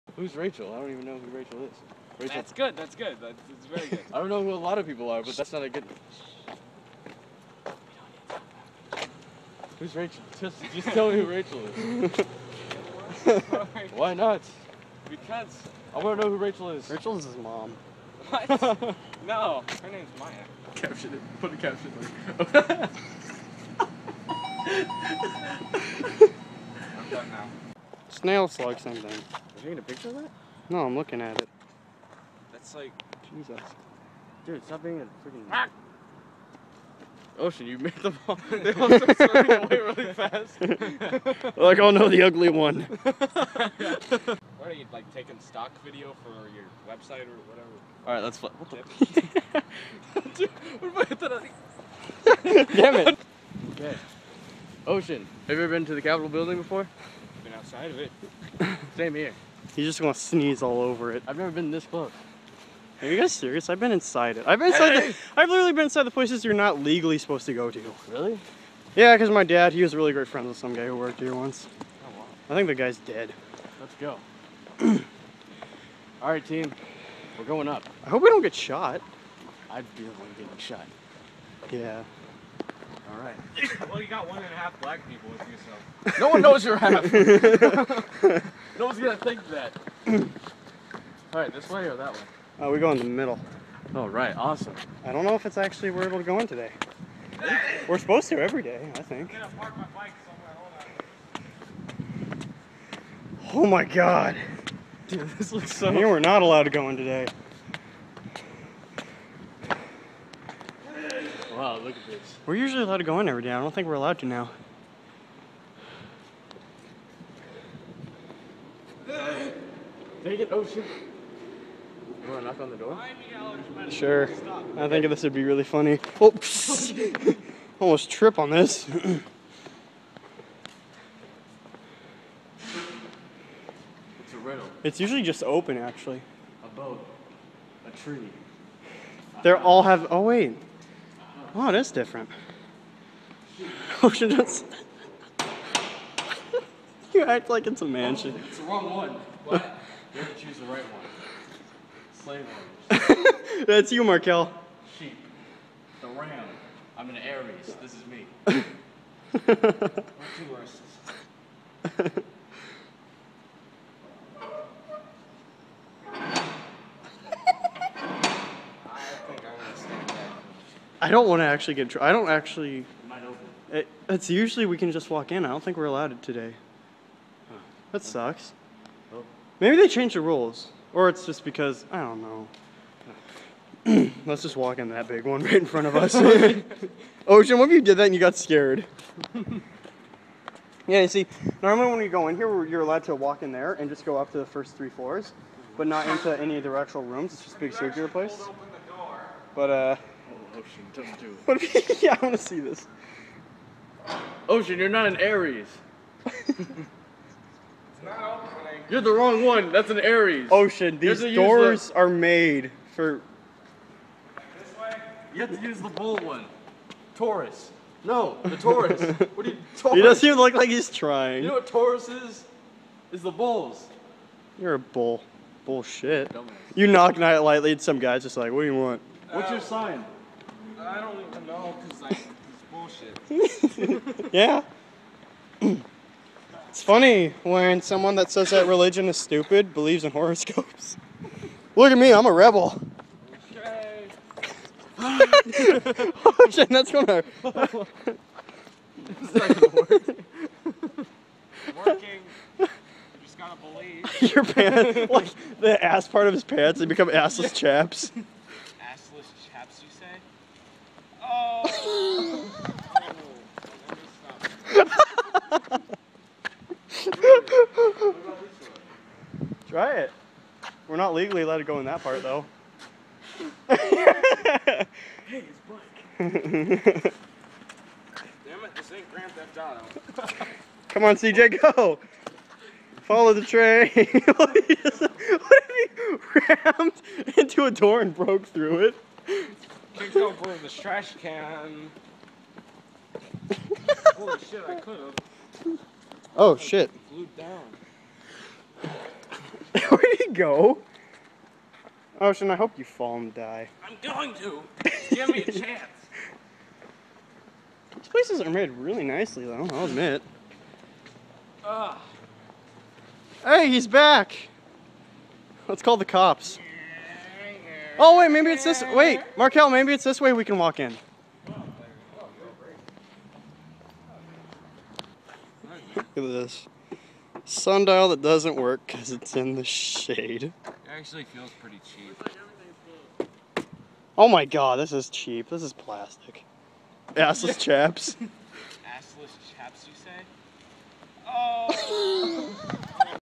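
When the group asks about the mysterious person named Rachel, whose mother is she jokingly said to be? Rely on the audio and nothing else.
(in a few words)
his mom.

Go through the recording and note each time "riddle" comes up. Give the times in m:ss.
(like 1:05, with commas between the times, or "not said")
2:14.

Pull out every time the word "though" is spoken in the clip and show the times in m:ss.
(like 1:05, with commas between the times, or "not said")
4:32, 5:09.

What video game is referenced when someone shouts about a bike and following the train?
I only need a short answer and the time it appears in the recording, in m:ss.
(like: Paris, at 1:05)
Grand Theft Auto, at 4:39.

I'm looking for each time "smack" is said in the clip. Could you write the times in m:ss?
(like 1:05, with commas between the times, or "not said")
not said.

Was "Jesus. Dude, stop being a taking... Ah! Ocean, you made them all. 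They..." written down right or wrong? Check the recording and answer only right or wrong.
wrong.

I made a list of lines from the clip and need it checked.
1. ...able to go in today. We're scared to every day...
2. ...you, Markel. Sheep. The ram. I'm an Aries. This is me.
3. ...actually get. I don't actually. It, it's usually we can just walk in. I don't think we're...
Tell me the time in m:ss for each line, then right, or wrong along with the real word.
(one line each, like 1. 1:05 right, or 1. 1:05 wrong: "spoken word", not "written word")
1. 1:36 wrong: "supposed", not "scared"
2. 2:33 right
3. 2:51 right.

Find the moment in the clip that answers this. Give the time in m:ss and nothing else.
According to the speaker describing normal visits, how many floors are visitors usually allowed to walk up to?
3:14.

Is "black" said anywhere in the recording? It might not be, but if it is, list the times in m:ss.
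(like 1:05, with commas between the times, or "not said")
1:24.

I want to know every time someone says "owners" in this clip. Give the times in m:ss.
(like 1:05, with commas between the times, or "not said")
2:32.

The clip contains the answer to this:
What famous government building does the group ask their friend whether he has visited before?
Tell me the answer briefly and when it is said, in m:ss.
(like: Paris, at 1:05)
Capitol building, at 0:56.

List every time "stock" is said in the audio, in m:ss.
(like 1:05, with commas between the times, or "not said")
0:45.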